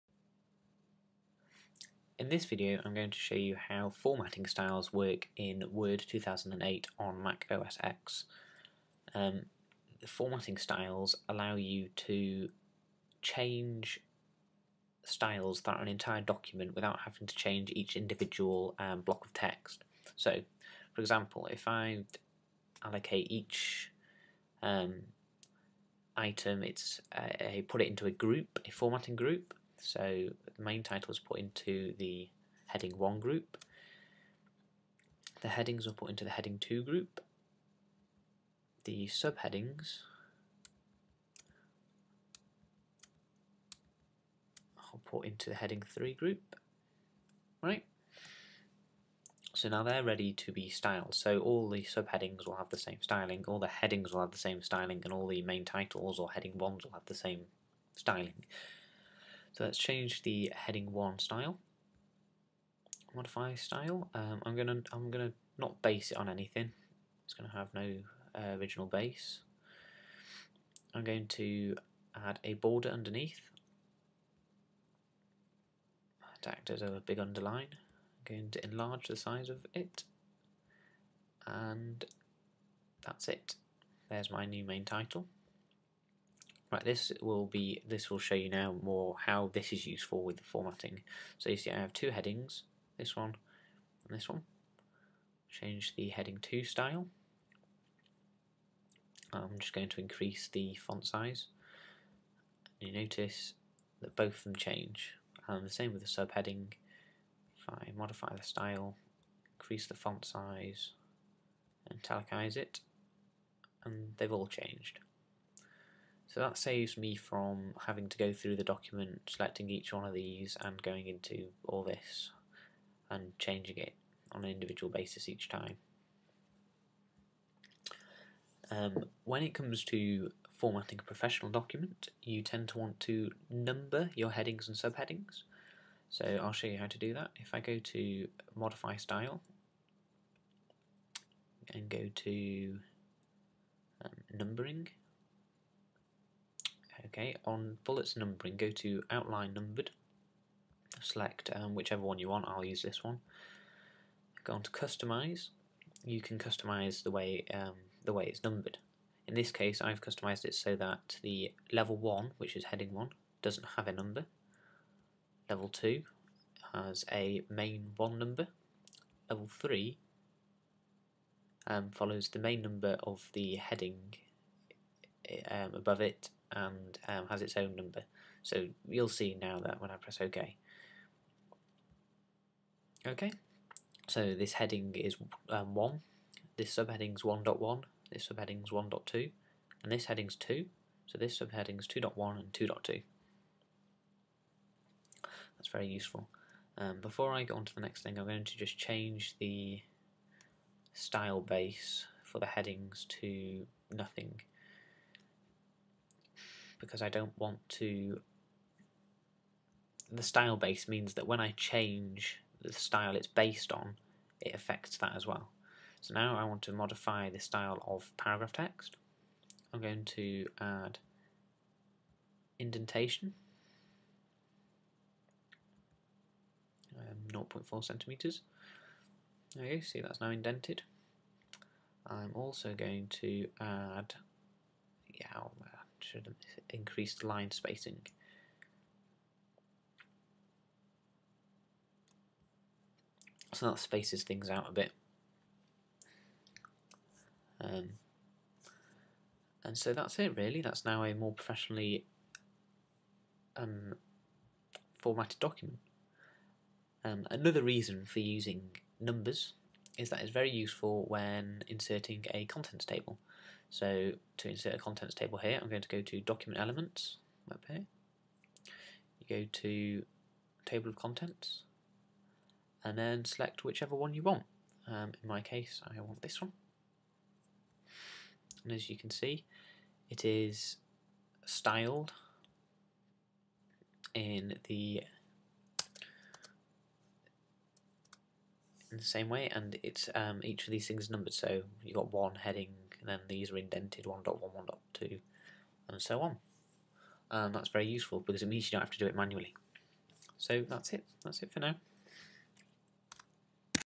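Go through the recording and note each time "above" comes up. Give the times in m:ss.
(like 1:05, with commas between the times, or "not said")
2:55.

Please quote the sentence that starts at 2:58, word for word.
So you'll see now that when I press OK.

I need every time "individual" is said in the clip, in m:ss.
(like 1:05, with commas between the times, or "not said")
0:17, 2:04.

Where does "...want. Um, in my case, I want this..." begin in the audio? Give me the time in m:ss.
4:34.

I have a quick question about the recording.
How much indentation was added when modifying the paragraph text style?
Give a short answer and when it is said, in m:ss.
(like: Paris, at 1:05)
0.4 centimeters, at 3:47.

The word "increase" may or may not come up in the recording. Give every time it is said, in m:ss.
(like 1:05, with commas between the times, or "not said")
1:40, 1:49, 3:56.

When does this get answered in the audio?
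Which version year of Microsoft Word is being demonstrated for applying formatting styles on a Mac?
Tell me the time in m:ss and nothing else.
0:06.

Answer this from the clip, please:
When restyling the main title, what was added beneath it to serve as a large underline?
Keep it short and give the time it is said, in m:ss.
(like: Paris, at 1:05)
A border, at 1:12.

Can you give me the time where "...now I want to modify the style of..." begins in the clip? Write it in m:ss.
3:36.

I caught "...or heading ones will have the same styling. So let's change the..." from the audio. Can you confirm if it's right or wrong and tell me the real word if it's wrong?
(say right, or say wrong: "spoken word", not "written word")
right.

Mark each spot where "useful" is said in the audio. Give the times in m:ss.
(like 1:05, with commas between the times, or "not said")
1:29, 3:15, 4:20, 4:57.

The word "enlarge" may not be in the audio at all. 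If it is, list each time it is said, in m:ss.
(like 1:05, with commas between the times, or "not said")
1:18.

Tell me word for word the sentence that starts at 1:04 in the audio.
Um, I'm gonna I'm gonna not base it on anything.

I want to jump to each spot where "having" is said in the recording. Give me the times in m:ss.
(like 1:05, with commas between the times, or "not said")
0:16, 1:57.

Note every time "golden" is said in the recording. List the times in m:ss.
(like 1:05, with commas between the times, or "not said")
not said.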